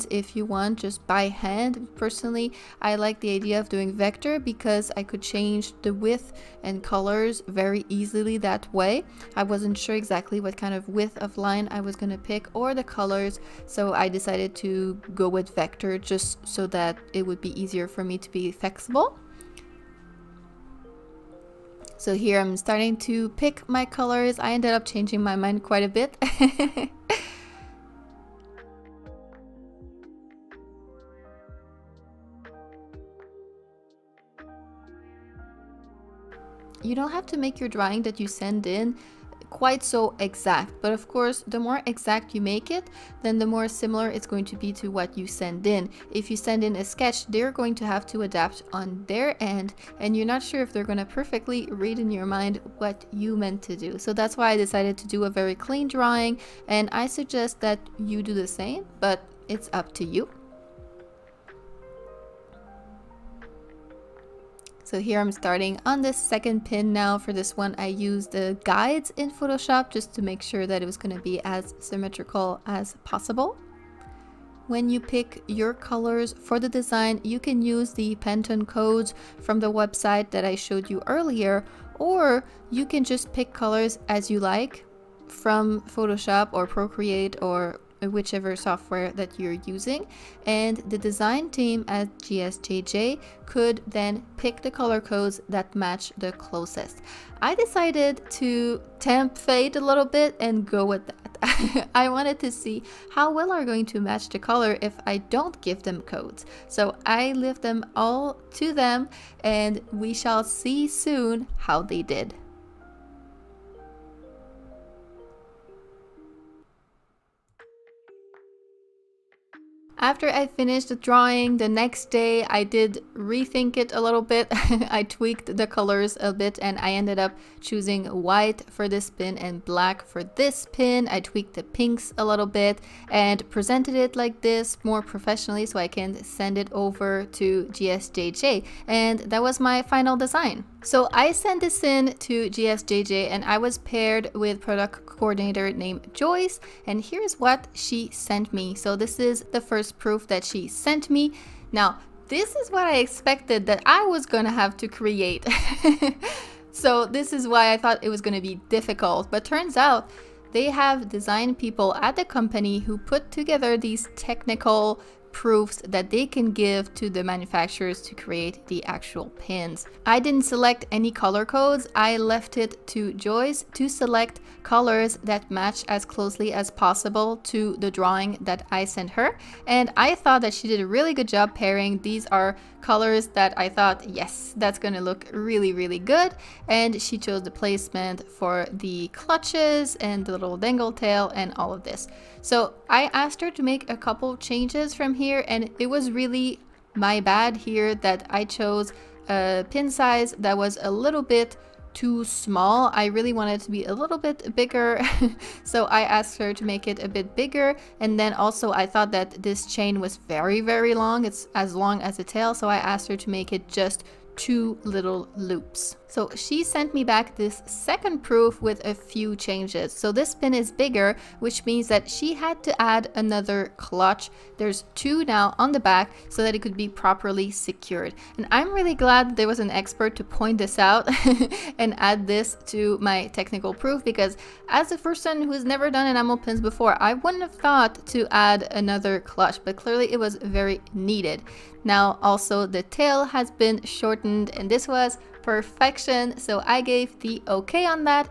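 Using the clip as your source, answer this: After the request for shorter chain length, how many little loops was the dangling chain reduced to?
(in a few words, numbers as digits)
2.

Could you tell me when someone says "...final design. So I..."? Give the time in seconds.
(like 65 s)
139 s.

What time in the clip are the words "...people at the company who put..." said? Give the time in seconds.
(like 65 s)
161 s.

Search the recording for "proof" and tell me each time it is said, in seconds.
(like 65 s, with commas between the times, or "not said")
149 s, 165 s, 218 s, 233 s.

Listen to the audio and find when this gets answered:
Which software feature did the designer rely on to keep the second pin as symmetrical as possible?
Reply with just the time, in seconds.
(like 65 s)
68 s.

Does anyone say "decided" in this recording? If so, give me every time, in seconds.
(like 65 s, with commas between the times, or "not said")
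14 s, 54 s, 97 s.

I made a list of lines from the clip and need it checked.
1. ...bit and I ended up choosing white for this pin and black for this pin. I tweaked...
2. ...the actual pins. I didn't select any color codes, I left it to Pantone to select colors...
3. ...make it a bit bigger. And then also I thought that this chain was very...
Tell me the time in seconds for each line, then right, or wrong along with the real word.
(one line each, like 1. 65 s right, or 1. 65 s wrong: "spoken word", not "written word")
1. 126 s right
2. 168 s wrong: "Joyce", not "Pantone"
3. 206 s right.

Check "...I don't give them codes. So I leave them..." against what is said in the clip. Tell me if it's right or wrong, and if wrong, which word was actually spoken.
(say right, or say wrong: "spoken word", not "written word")
right.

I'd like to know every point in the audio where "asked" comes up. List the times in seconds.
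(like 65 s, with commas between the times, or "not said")
193 s, 206 s, 212 s.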